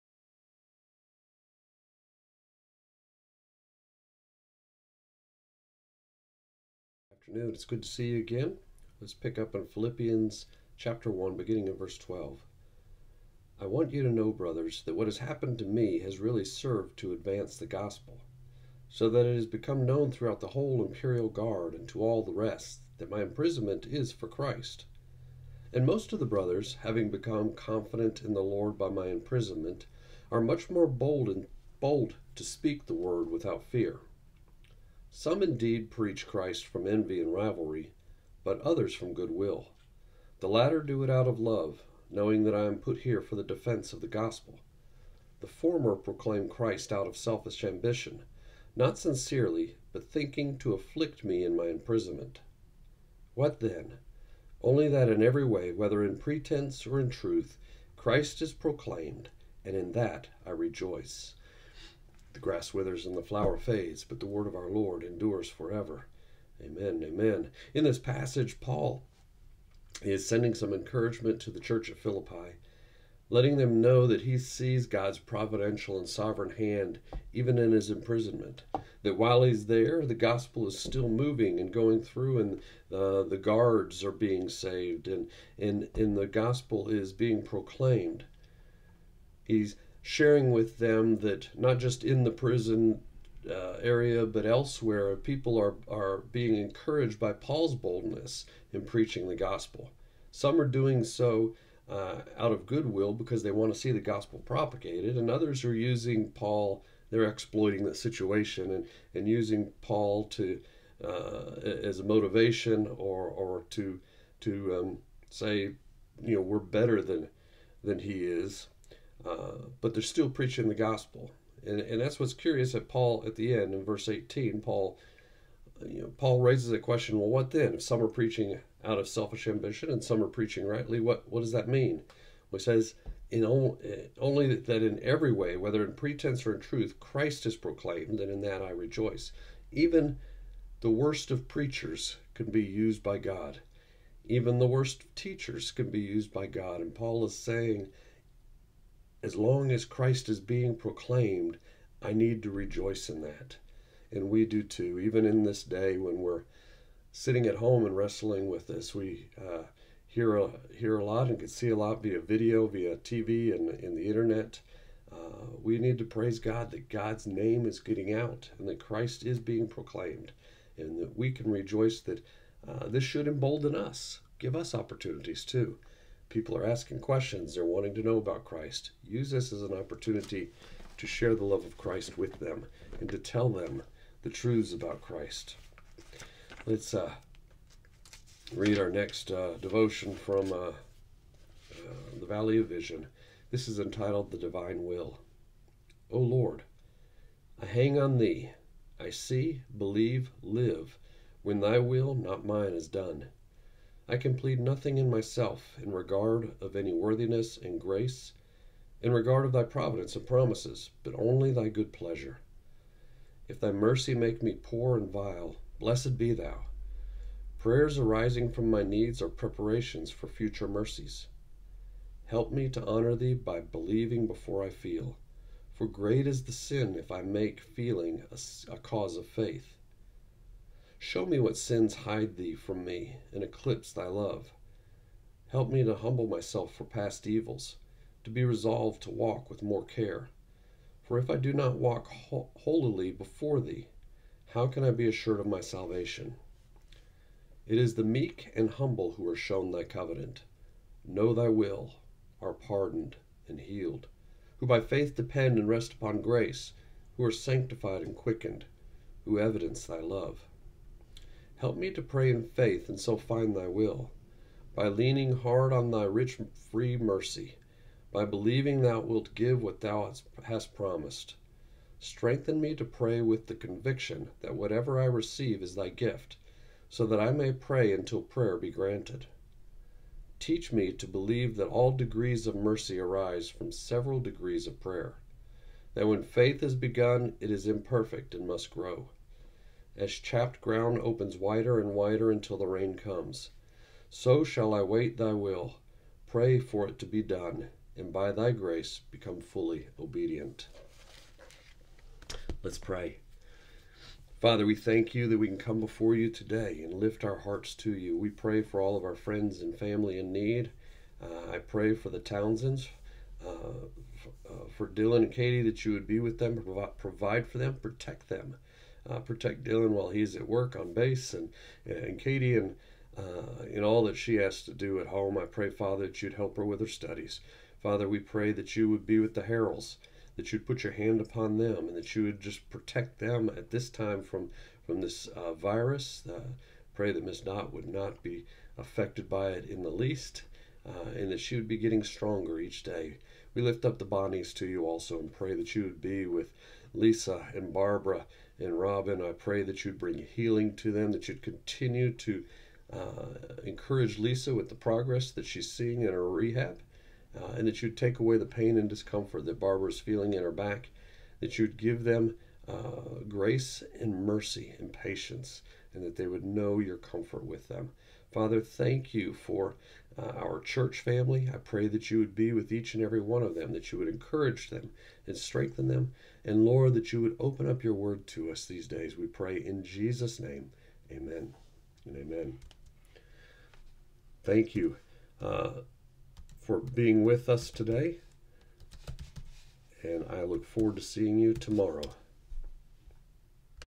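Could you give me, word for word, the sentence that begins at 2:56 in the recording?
People are asking questions, they're wanting to know about Christ.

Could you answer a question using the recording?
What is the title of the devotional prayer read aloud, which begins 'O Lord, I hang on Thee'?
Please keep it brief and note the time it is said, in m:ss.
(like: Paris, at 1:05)
The Divine Will, at 3:14.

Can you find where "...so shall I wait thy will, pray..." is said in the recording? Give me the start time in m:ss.
4:54.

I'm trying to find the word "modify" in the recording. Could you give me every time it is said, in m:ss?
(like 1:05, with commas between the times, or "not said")
not said.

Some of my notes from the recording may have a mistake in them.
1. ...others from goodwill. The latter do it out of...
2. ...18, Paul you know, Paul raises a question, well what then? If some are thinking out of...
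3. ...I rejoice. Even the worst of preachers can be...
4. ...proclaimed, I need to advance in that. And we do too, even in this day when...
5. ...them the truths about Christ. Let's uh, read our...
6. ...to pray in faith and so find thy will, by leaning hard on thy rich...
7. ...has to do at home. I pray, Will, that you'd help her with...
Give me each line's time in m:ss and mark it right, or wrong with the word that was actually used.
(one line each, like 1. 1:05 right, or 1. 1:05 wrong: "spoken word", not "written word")
1. 0:38 right
2. 2:04 wrong: "preaching", not "thinking"
3. 2:18 right
4. 2:30 wrong: "rejoice", not "advance"
5. 3:03 right
6. 4:21 right
7. 5:24 wrong: "Father", not "Will".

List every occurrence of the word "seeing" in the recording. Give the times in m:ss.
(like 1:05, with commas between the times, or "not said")
5:55, 6:31.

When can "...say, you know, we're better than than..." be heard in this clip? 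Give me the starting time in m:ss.
1:55.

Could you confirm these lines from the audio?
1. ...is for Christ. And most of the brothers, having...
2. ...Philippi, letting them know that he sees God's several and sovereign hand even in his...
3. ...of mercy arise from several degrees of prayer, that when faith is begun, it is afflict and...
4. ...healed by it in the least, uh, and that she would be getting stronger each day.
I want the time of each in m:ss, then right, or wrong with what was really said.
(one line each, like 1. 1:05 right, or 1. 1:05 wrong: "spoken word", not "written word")
1. 0:23 right
2. 1:11 wrong: "providential", not "several"
3. 4:42 wrong: "imperfect", not "afflict"
4. 5:38 wrong: "affected", not "healed".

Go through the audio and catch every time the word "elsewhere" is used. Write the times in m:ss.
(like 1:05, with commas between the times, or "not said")
1:34.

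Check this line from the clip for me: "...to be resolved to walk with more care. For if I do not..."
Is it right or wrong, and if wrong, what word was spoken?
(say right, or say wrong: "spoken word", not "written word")
right.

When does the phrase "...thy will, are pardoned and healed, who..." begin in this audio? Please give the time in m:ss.
4:11.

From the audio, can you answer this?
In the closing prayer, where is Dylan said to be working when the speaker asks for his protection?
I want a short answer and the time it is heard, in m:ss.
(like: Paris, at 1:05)
On base, at 5:20.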